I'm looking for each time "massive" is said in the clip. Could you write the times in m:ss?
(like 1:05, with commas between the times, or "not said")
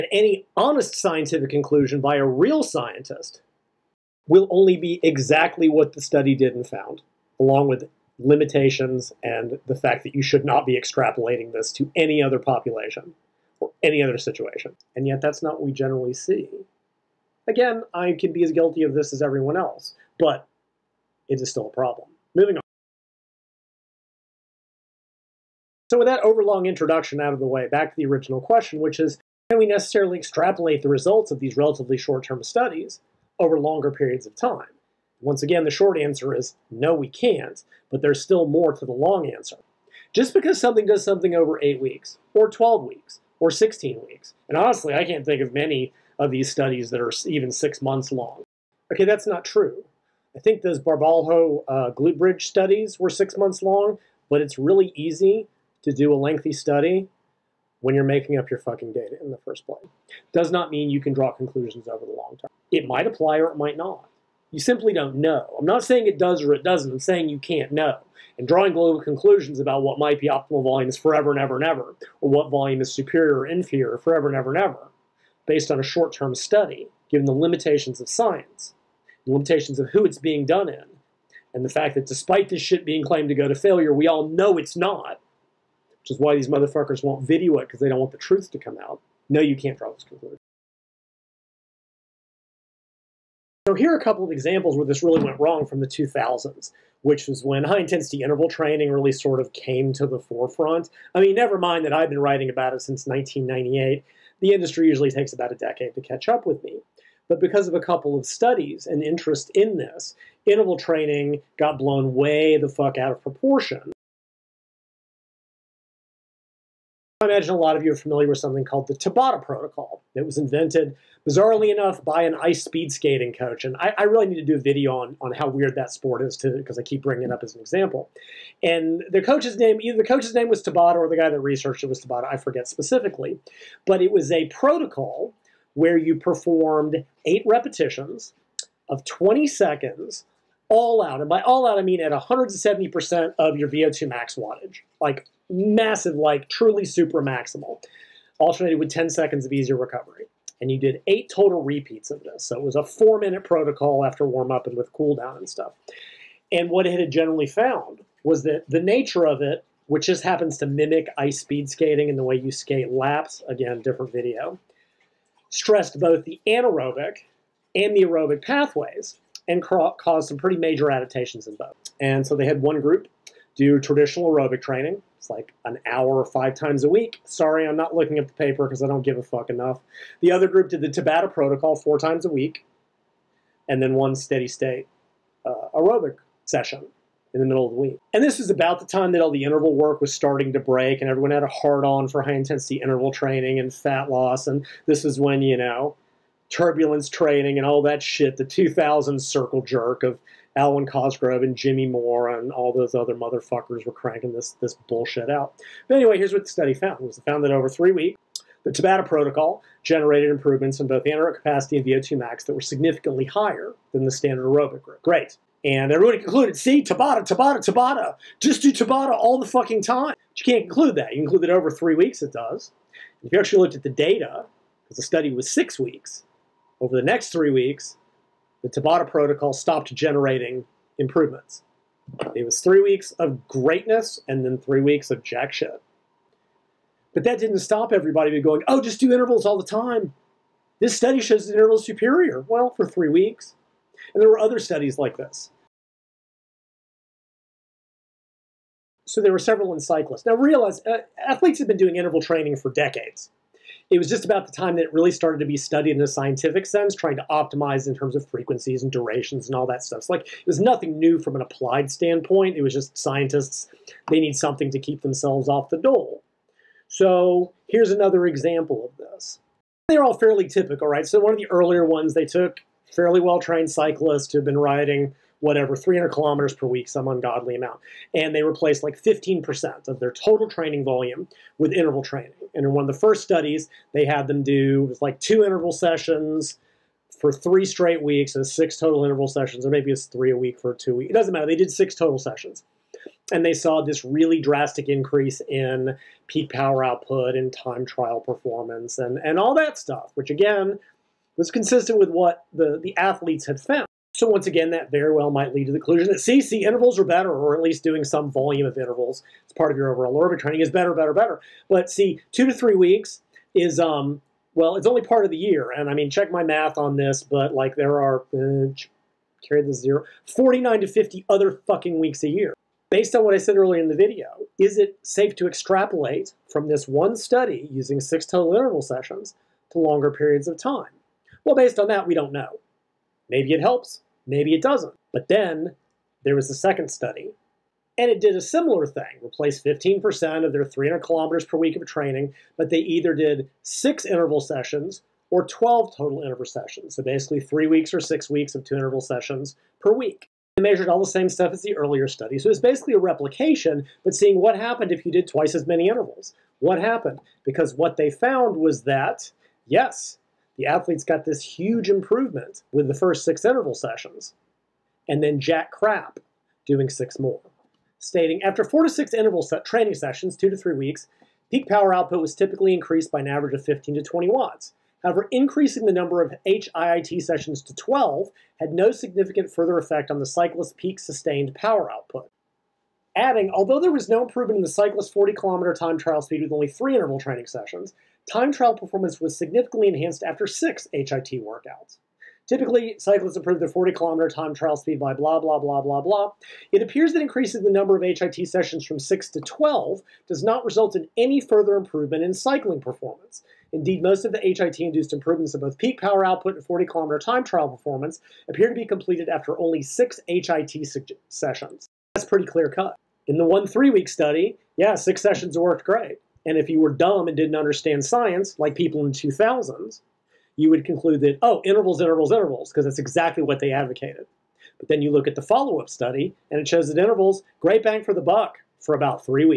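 2:25.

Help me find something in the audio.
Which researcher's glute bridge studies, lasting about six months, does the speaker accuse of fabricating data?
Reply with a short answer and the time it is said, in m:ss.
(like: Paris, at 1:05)
Barbalho, at 0:50.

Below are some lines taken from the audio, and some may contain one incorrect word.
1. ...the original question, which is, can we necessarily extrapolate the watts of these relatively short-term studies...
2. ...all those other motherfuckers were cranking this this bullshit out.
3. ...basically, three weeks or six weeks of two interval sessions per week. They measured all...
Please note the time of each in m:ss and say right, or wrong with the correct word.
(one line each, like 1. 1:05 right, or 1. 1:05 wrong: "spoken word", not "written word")
1. 0:27 wrong: "results", not "watts"
2. 3:22 right
3. 5:47 right.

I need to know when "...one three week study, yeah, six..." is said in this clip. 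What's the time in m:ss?
6:53.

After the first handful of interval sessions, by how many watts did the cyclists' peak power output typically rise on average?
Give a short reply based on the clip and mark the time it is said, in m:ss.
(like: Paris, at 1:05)
15 to 20 watts, at 6:13.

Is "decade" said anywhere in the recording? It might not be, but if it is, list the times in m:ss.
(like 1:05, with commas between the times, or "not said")
1:45, 4:12.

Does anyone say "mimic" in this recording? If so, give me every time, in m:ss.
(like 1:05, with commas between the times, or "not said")
2:40.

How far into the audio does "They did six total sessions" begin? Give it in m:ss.
4:51.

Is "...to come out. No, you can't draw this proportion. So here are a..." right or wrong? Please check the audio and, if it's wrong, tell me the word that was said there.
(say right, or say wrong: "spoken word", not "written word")
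wrong: "conclusion", not "proportion".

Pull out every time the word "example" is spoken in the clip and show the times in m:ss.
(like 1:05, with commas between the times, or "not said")
1:34, 2:07, 4:28.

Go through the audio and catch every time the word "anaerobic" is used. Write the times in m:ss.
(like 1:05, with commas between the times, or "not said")
2:46, 3:31.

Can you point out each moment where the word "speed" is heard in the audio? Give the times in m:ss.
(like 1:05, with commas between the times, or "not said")
2:02, 2:41, 6:26, 6:34.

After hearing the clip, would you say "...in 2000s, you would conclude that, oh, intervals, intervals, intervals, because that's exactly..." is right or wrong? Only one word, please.
right.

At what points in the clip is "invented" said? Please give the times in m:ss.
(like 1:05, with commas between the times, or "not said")
2:00.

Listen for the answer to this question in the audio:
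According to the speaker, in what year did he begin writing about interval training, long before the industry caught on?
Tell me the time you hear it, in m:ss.
1:43.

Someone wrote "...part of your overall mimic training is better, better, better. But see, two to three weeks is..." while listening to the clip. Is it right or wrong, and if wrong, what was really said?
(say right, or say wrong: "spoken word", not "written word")
wrong: "aerobic", not "mimic".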